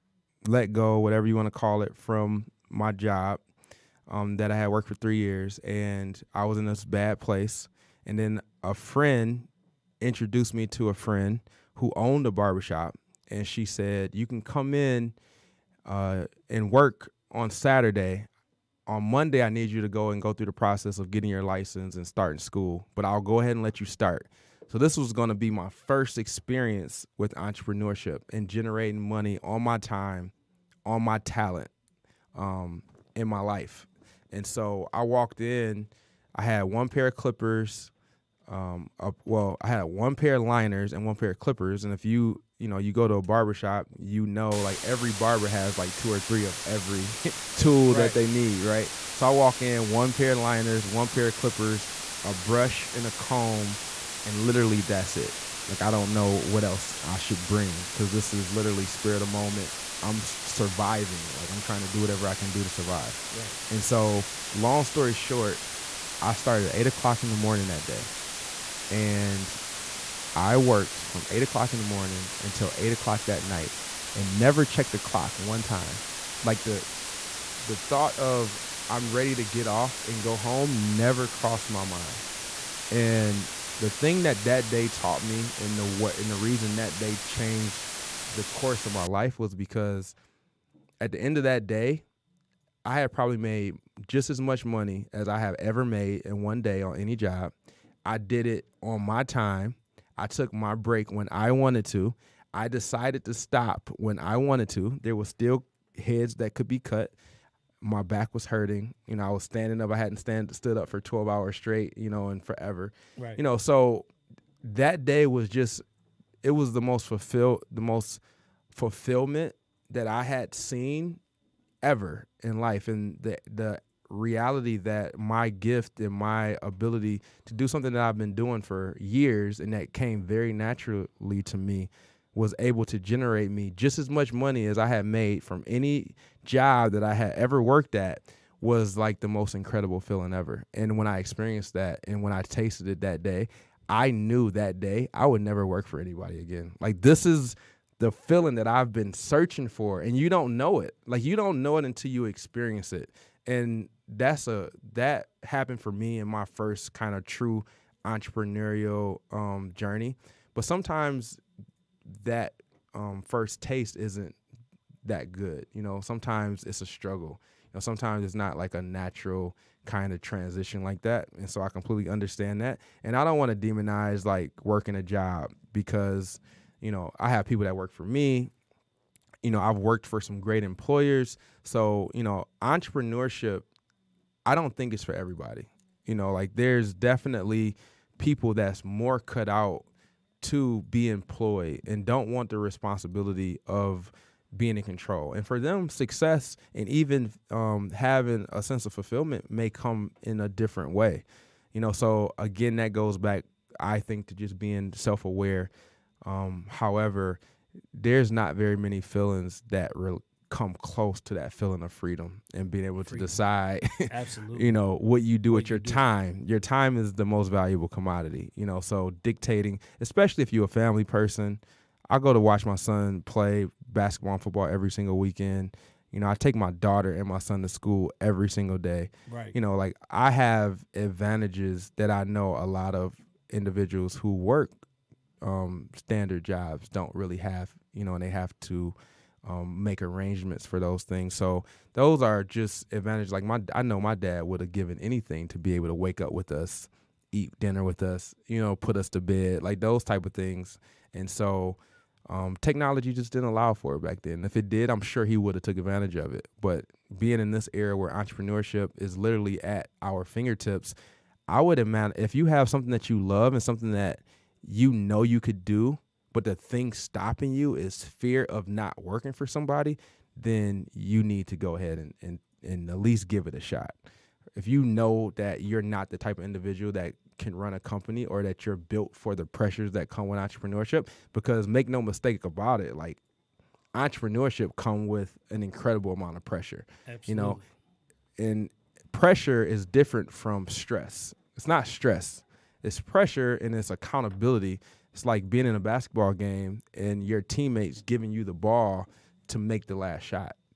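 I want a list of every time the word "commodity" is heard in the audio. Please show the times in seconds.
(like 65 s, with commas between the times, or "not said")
217 s.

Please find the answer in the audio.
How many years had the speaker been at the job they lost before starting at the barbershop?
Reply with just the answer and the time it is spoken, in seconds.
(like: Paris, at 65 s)
3, at 4 s.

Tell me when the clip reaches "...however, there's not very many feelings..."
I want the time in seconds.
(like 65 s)
206 s.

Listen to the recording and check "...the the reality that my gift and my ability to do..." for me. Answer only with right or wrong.
right.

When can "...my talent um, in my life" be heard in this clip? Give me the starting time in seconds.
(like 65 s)
31 s.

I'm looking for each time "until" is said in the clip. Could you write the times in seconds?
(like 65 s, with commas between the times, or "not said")
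72 s, 151 s.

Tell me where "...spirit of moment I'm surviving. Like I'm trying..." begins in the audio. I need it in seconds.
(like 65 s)
58 s.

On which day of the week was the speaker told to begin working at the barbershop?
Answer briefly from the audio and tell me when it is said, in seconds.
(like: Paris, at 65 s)
Saturday, at 17 s.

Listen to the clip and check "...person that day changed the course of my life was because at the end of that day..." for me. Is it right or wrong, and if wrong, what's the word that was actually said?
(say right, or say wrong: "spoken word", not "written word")
wrong: "reason", not "person".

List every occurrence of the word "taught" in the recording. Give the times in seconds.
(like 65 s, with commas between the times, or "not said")
84 s.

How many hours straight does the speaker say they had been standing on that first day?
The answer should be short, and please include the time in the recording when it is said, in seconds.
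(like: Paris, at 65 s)
12, at 111 s.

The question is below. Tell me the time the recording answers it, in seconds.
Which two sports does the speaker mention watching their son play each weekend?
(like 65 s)
223 s.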